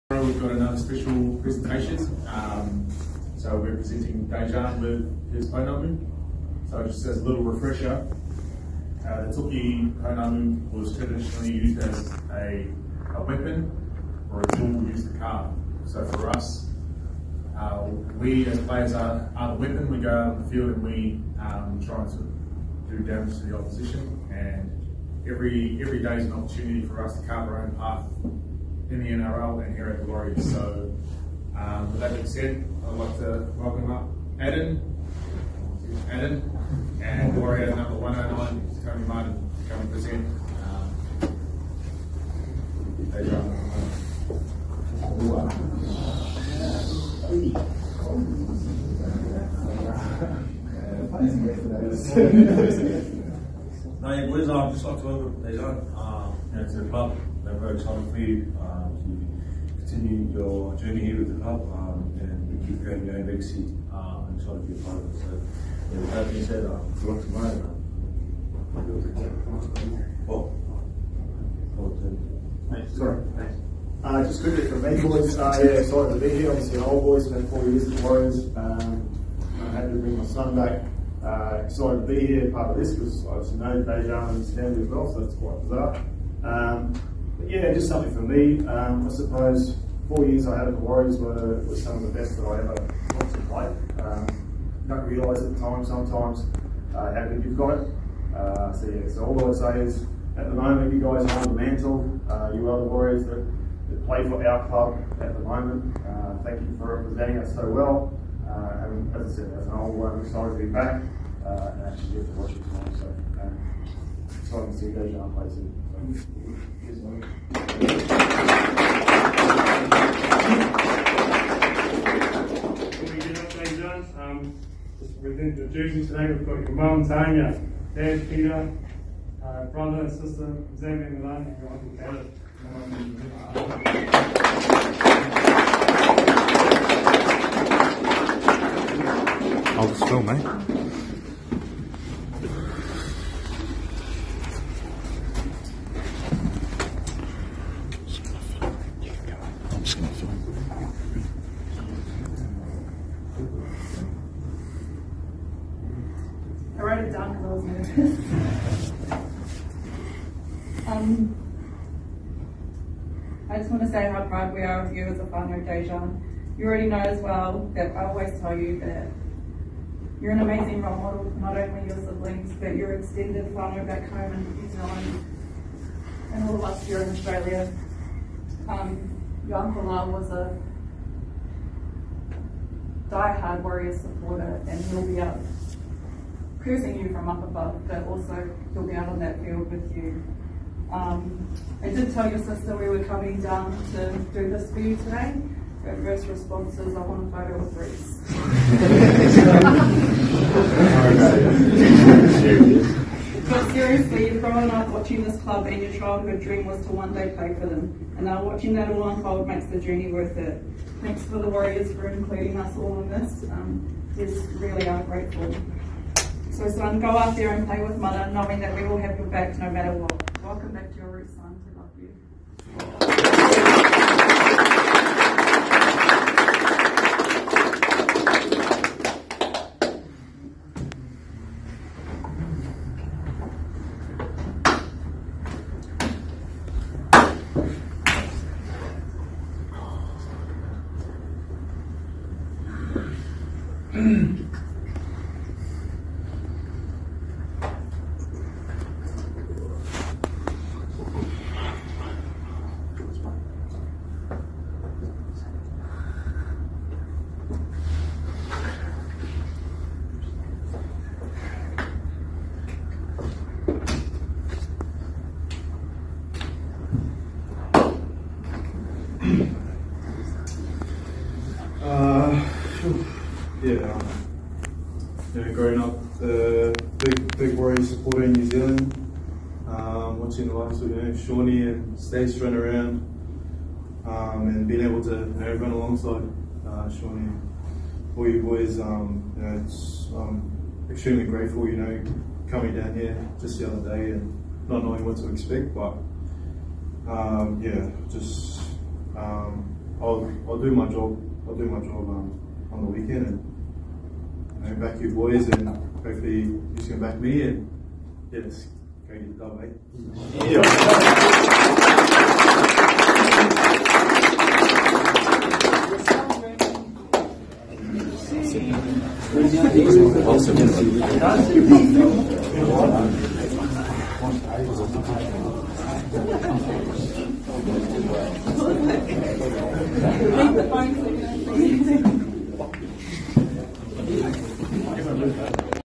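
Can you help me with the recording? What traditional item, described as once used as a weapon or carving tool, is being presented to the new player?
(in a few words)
toki pounamu.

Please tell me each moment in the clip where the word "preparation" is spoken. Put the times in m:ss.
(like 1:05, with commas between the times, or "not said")
not said.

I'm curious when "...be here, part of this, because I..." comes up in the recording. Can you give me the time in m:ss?
1:22.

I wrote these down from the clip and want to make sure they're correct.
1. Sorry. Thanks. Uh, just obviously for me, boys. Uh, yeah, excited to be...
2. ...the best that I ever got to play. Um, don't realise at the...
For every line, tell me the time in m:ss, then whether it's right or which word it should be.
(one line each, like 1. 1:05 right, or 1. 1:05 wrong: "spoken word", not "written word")
1. 1:12 wrong: "quickly", not "obviously"
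2. 1:32 right.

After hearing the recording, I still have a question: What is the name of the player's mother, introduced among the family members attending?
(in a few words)
Tanya.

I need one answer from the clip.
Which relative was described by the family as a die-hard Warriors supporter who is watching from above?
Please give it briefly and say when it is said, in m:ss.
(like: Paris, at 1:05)
Uncle Lyle, at 2:59.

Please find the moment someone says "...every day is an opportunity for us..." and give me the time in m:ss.
0:25.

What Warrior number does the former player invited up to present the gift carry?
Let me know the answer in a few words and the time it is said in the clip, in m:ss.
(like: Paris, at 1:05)
109, at 0:37.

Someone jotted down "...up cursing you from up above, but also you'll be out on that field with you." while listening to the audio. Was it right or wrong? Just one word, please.
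right.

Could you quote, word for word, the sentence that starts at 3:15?
First response is I want a photo with Bruce.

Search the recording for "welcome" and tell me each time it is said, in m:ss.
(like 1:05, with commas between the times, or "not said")
0:33, 3:40.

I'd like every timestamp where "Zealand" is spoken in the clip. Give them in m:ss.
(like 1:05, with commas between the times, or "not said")
2:54, 4:38.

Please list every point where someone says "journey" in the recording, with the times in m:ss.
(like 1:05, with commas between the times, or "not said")
1:00, 3:29.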